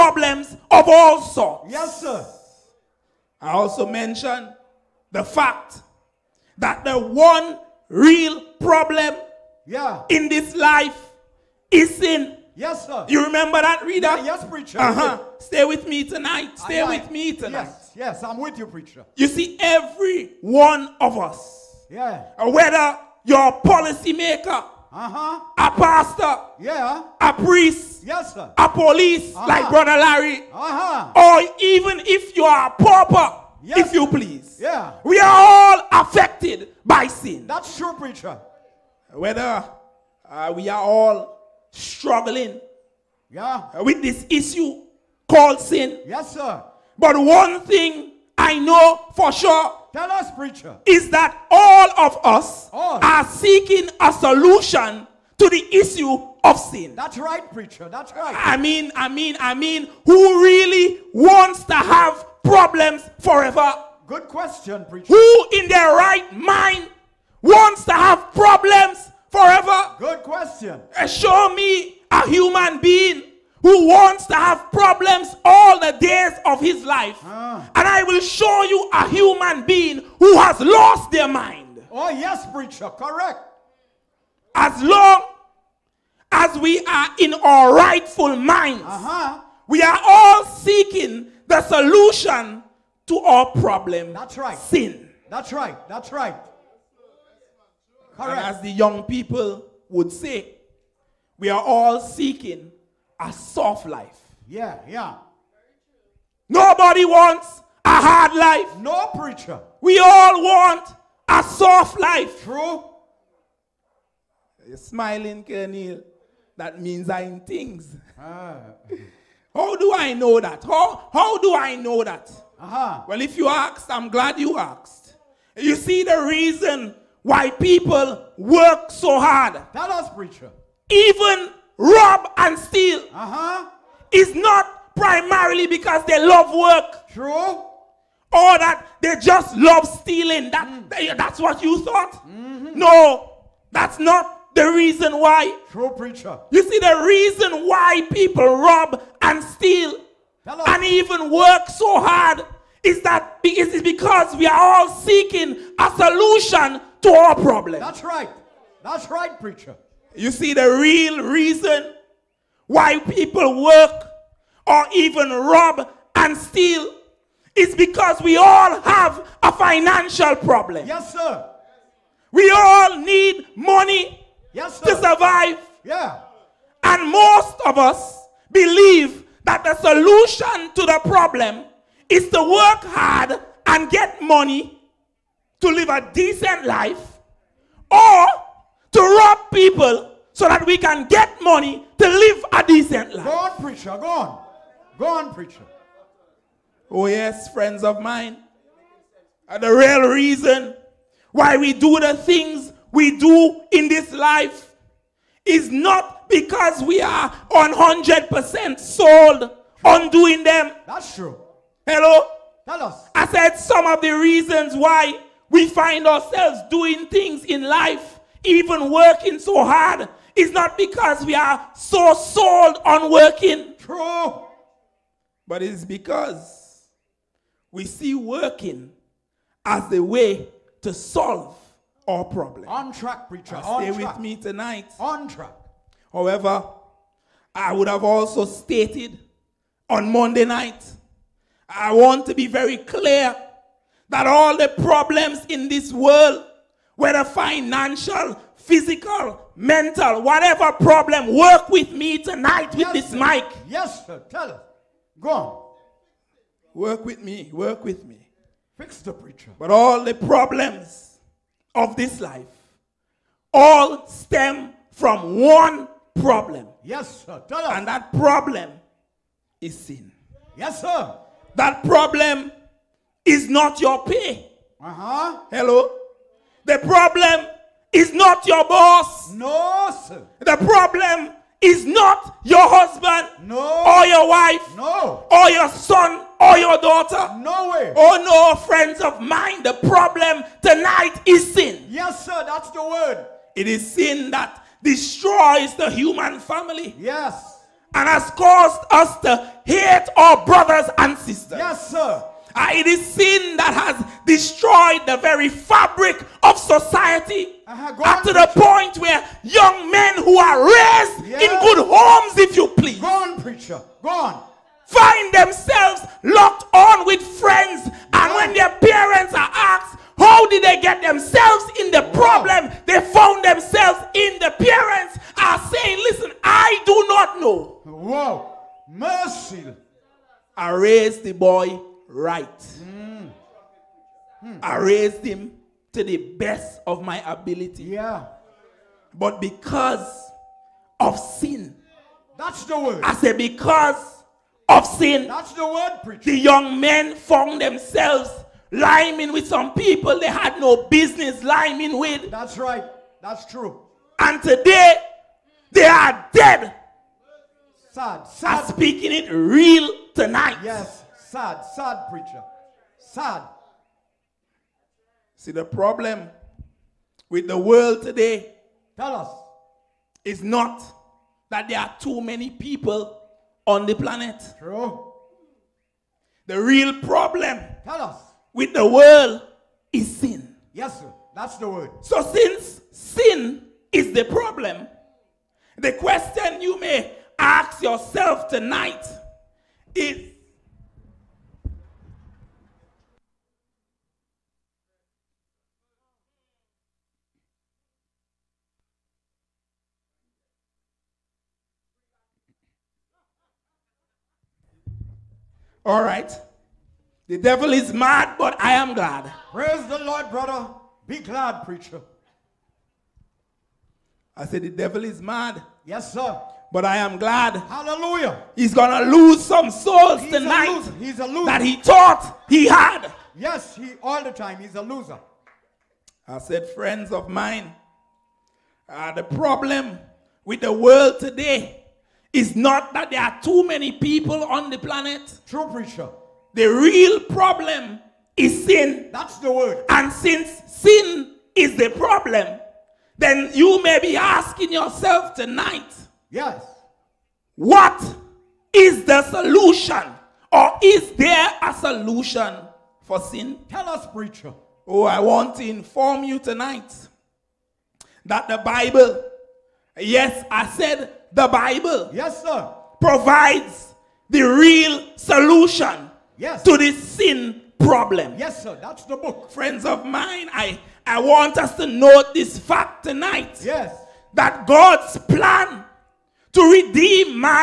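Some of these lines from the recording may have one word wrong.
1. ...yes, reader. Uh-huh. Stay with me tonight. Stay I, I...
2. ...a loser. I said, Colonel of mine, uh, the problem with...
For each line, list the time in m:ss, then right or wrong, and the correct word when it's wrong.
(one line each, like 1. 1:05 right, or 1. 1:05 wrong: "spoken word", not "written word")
1. 0:14 wrong: "preacher", not "reader"
2. 7:04 wrong: "Friends", not "Colonel".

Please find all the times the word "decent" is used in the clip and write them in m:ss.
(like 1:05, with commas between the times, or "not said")
3:06, 3:12.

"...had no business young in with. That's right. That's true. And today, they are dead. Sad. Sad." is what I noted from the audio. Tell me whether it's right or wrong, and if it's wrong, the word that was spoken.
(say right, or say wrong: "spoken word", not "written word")
wrong: "lying", not "young".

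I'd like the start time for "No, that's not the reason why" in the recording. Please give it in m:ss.
2:22.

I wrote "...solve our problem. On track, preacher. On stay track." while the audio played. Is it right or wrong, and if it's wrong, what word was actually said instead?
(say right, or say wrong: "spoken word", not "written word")
right.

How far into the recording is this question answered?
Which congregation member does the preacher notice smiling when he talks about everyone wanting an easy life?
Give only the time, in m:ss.
1:55.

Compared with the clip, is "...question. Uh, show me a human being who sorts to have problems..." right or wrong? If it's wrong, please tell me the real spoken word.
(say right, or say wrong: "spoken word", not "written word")
wrong: "wants", not "sorts".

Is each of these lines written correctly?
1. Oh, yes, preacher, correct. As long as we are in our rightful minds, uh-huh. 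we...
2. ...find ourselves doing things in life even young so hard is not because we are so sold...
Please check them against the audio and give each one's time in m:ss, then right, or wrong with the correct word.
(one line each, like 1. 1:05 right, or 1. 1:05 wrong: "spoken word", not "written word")
1. 1:21 right
2. 3:35 wrong: "working", not "young".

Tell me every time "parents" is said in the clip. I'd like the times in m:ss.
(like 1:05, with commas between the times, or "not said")
5:18, 5:24.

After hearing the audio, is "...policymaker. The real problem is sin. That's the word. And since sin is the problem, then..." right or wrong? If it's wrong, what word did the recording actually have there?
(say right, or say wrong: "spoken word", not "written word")
wrong: "preacher", not "policymaker".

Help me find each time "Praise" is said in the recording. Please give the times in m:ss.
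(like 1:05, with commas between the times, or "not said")
6:49.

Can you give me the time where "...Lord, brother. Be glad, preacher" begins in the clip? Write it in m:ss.
6:49.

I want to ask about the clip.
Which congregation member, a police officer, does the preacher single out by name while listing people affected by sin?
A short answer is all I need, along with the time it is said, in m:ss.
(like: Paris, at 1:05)
Brother Larry, at 0:29.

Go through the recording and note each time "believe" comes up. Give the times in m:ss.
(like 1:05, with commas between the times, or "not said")
2:58.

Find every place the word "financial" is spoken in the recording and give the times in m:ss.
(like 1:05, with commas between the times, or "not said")
2:49, 4:07.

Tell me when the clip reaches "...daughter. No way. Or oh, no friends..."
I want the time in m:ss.
4:46.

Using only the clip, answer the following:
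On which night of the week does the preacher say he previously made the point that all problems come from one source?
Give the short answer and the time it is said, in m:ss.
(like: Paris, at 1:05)
Monday, at 4:00.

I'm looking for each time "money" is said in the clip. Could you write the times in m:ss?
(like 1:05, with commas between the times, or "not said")
2:53, 3:04, 3:11.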